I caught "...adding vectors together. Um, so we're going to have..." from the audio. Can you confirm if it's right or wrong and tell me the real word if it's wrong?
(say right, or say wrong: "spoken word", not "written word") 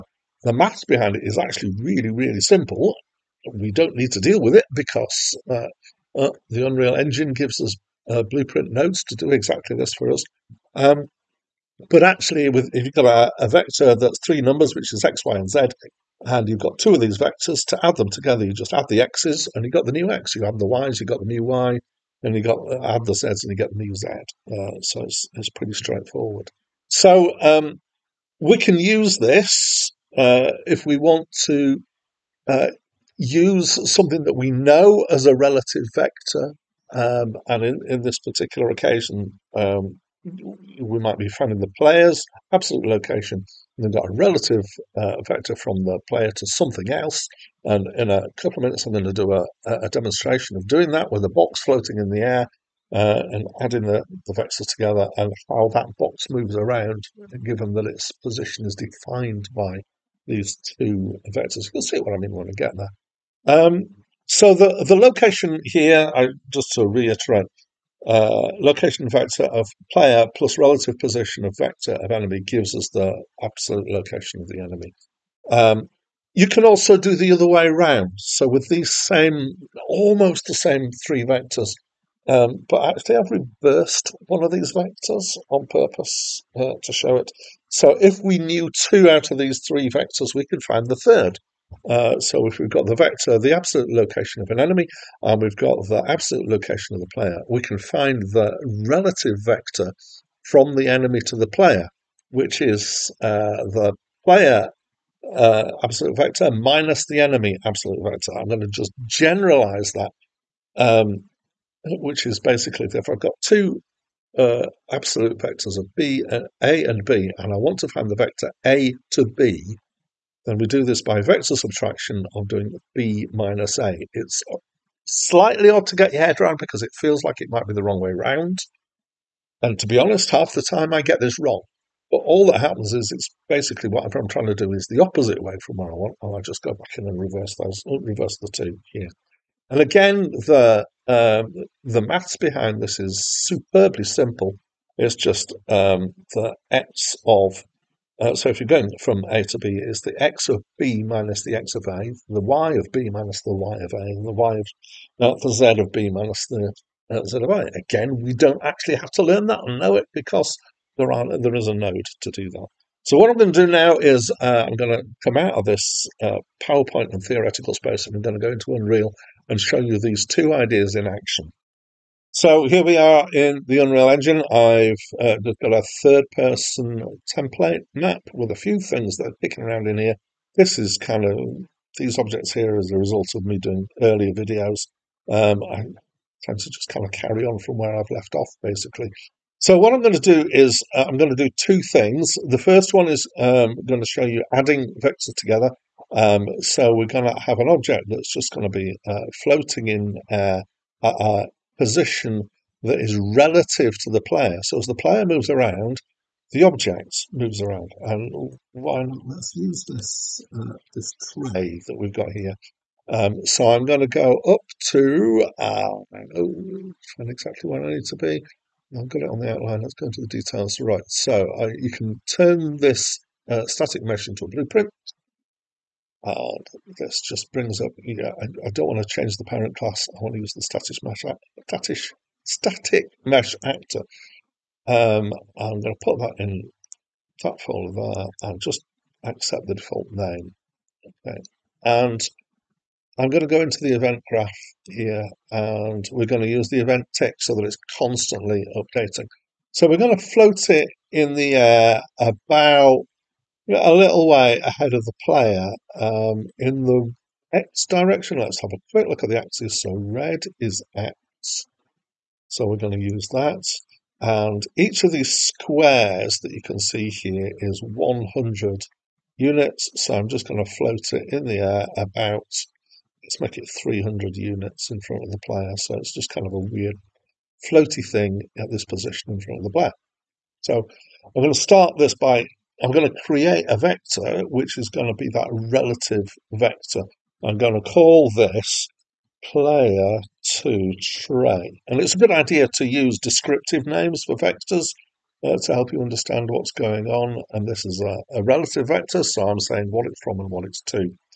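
right.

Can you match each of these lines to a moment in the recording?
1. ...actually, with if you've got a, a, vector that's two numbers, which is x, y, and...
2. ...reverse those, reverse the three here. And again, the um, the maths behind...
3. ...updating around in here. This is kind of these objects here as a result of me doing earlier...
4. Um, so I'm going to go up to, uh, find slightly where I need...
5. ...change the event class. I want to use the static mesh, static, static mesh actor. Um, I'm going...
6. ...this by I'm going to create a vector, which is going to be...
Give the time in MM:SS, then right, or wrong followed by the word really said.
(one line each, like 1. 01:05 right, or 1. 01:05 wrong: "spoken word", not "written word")
1. 00:12 wrong: "three", not "two"
2. 02:17 wrong: "two", not "three"
3. 02:59 wrong: "picking", not "updating"
4. 03:33 wrong: "exactly", not "slightly"
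5. 03:49 wrong: "parent", not "event"
6. 04:41 right.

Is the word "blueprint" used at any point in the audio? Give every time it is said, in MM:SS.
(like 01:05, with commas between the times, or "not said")
00:08, 03:44.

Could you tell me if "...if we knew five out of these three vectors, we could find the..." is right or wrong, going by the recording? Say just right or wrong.
wrong.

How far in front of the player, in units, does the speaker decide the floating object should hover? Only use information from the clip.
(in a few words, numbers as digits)
300 units.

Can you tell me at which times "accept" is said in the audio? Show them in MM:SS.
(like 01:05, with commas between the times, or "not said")
03:59.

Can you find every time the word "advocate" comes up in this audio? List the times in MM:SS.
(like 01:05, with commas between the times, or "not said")
not said.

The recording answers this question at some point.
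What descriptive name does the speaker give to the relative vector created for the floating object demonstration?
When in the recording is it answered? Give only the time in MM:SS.
04:49.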